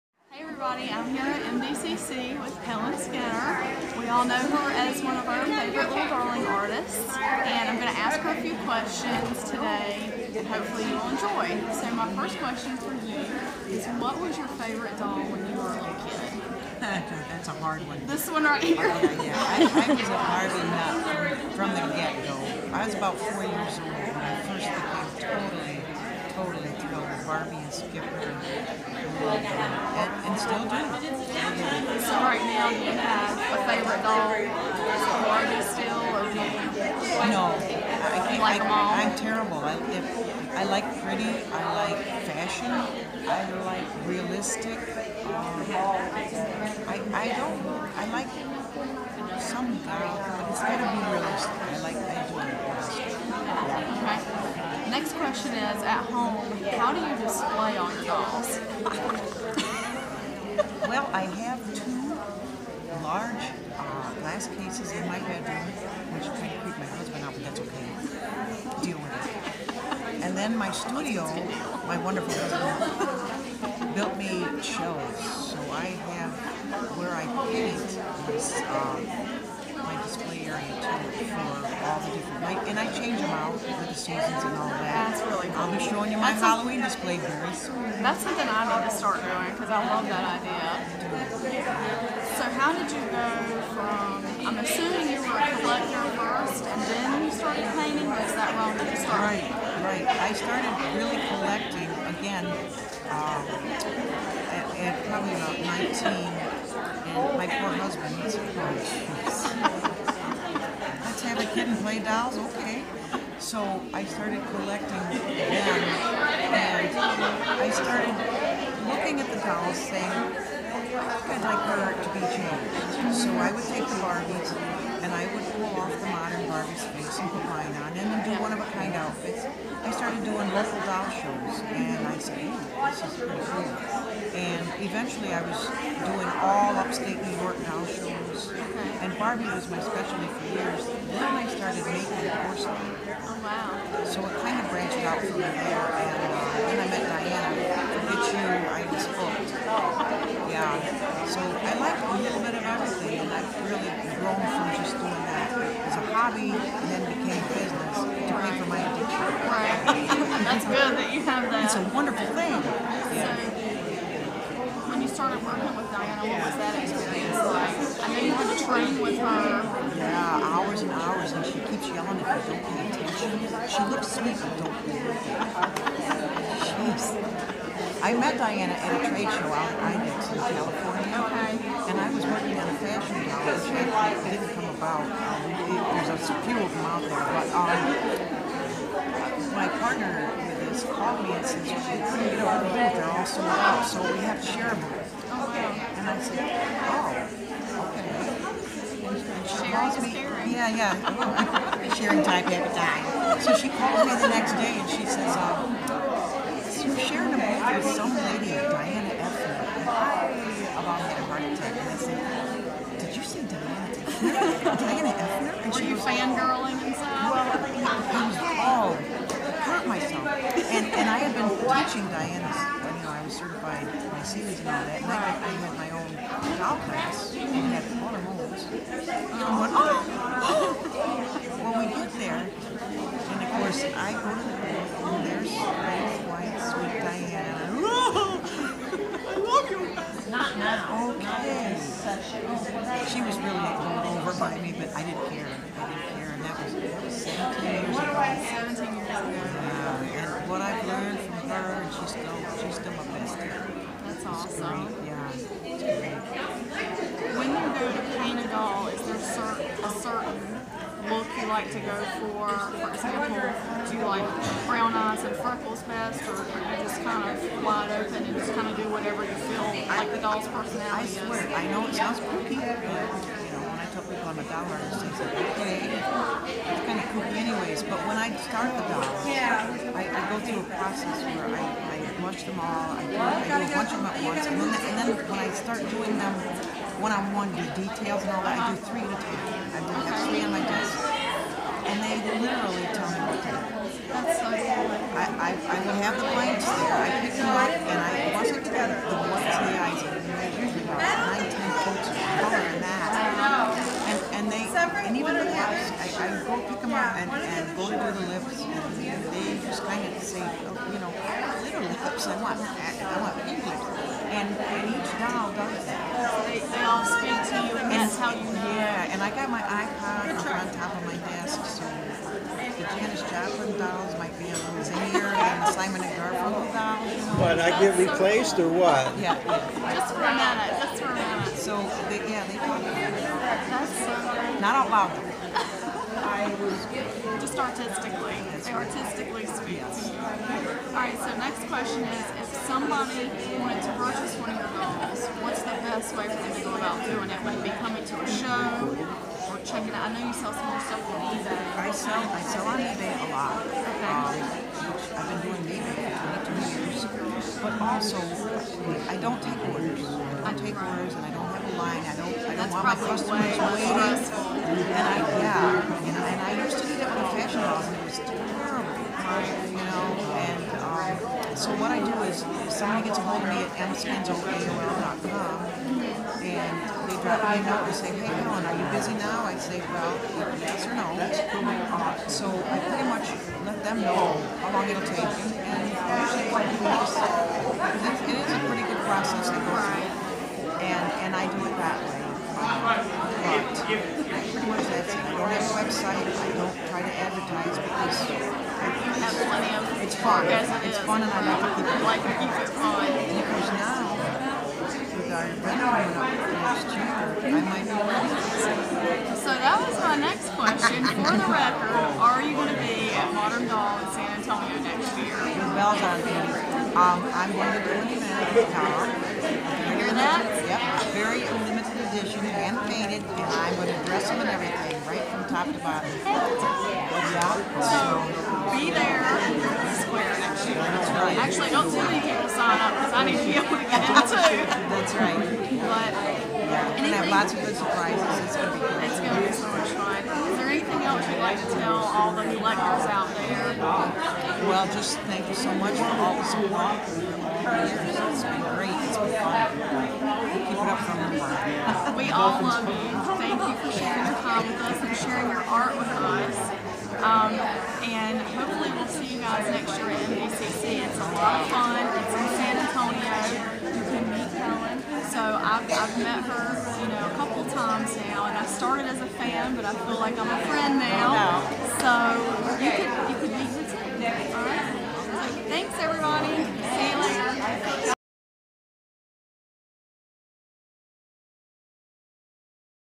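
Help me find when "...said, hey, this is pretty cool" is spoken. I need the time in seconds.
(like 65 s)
132 s.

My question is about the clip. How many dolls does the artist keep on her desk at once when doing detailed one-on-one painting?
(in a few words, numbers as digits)
3.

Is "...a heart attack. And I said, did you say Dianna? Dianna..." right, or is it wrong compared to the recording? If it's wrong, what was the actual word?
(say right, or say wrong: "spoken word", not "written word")
right.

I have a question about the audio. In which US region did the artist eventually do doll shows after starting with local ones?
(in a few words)
Upstate New York.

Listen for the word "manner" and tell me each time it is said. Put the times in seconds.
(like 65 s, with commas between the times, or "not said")
not said.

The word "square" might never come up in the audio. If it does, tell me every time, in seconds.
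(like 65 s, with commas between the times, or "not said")
430 s.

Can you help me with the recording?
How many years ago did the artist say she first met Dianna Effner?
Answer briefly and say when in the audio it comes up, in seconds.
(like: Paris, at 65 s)
17, at 247 s.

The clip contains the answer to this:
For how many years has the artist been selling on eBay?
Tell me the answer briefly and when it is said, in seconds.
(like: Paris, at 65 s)
22, at 356 s.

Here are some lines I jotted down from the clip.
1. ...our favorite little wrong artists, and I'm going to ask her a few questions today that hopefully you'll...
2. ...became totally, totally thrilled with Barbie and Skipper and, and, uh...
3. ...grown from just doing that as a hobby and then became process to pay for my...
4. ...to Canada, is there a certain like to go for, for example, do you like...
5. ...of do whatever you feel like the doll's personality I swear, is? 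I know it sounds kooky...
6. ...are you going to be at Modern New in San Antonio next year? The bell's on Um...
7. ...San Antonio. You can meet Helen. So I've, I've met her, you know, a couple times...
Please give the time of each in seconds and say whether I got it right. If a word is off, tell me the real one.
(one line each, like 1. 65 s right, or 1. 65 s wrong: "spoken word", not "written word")
1. 5 s wrong: "darling", not "wrong"
2. 24 s right
3. 154 s wrong: "business", not "process"
4. 257 s right
5. 268 s right
6. 412 s wrong: "Doll", not "New"
7. 462 s right.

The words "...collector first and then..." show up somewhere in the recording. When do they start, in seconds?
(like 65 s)
95 s.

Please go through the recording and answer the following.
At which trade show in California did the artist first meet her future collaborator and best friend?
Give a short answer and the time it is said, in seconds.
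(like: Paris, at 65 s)
IDEX, at 179 s.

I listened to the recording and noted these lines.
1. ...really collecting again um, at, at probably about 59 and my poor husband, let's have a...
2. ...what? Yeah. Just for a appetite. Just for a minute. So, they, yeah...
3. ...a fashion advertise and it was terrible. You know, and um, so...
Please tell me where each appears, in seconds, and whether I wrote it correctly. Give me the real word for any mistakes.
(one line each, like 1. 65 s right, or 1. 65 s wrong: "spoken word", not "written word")
1. 100 s wrong: "19", not "59"
2. 328 s wrong: "minute", not "appetite"
3. 367 s wrong: "house", not "advertise".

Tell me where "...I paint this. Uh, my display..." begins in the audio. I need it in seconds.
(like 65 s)
77 s.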